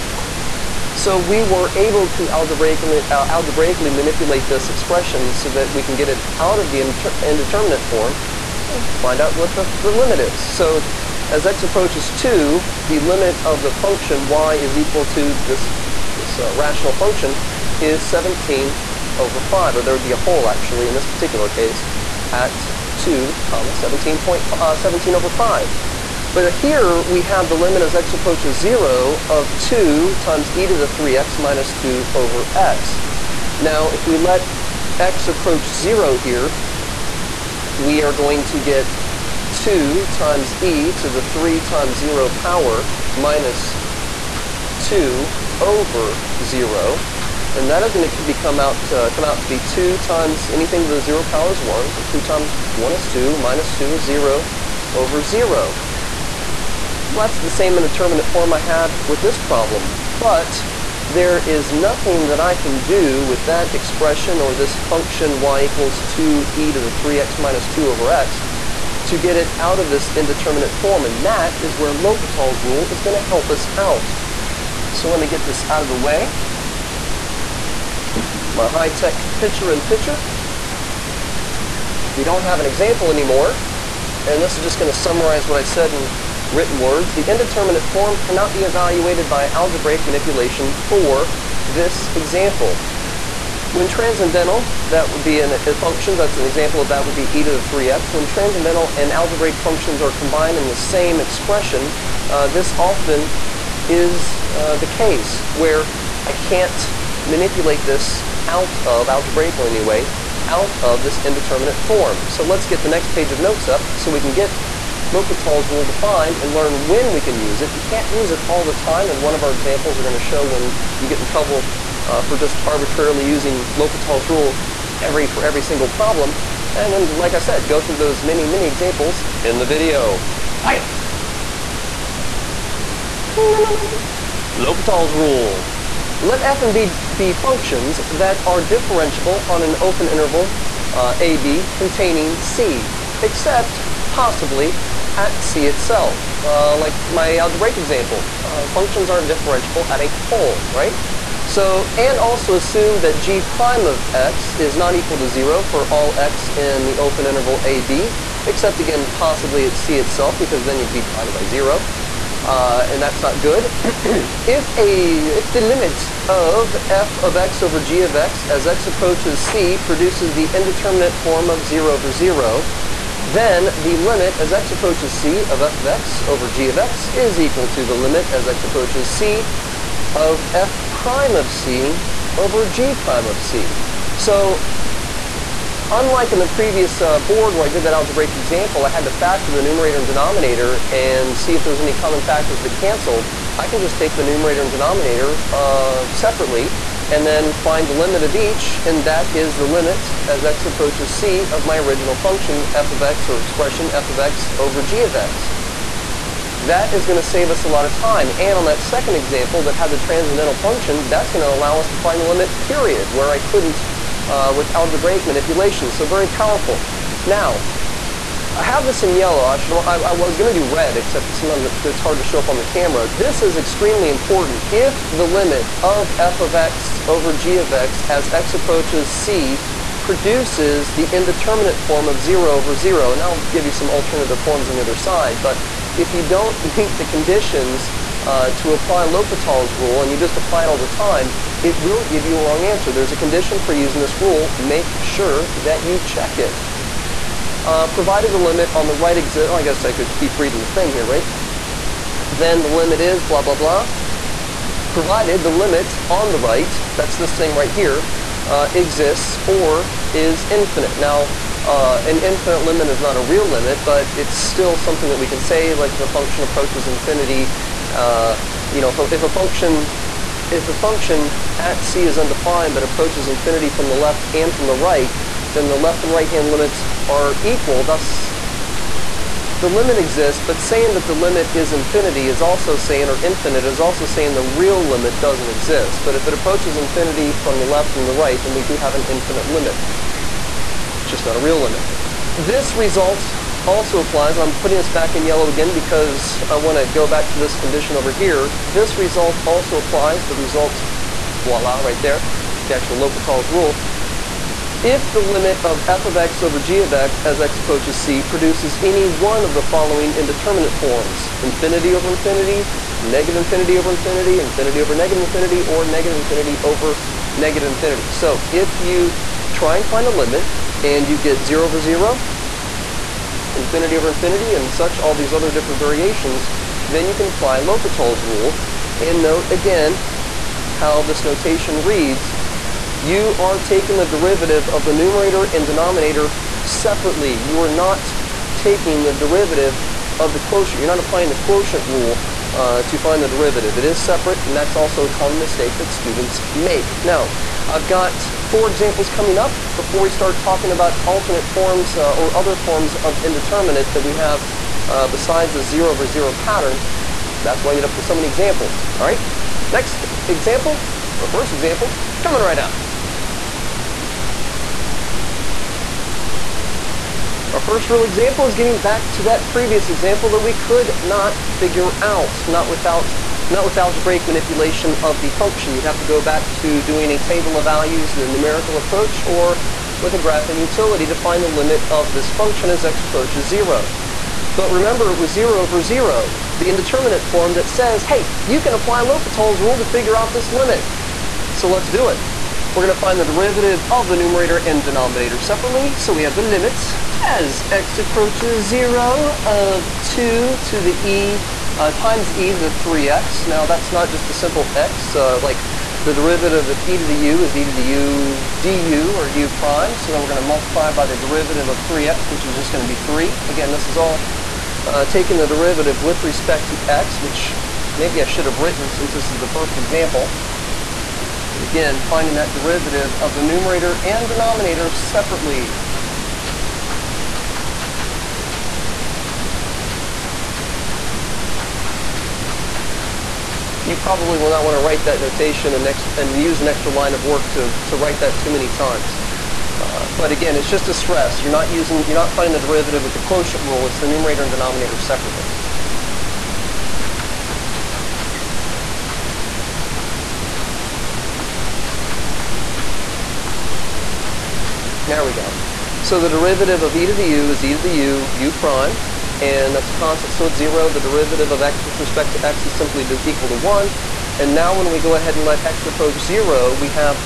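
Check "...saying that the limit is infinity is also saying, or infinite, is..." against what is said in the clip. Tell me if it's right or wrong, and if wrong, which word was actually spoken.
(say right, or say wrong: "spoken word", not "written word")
right.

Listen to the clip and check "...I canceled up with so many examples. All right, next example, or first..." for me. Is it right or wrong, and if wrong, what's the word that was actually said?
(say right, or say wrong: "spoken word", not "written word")
wrong: "ended", not "canceled".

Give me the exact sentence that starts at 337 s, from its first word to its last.
You are not taking the derivative of the quotient.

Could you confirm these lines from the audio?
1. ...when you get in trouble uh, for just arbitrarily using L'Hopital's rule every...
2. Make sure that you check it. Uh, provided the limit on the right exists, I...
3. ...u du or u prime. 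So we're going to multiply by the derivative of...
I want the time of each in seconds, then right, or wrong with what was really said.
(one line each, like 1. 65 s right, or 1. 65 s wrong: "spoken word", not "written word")
1. 120 s right
2. 244 s right
3. 407 s right.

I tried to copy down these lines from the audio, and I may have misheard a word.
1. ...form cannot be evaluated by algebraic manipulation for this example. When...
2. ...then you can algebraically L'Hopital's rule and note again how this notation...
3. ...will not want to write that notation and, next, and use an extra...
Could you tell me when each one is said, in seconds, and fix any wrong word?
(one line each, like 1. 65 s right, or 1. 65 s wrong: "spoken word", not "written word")
1. 87 s right
2. 326 s wrong: "apply", not "algebraically"
3. 434 s right.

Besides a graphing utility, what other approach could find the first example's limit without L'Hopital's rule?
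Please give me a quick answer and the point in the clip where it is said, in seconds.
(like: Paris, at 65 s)
Table of values, at 377 s.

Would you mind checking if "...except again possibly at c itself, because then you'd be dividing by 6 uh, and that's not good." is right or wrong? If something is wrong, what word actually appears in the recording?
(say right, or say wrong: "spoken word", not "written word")
wrong: "0", not "6".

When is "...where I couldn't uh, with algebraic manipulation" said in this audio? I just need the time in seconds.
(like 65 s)
213 s.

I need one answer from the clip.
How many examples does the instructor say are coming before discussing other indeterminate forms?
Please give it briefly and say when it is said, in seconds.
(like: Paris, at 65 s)
Four, at 348 s.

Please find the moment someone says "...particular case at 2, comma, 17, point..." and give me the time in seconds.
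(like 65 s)
21 s.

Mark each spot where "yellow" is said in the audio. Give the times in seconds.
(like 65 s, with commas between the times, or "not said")
219 s, 295 s.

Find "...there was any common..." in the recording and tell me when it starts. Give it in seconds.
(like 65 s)
191 s.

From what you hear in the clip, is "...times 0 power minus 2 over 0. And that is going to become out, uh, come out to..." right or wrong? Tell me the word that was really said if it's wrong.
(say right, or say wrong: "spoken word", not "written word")
right.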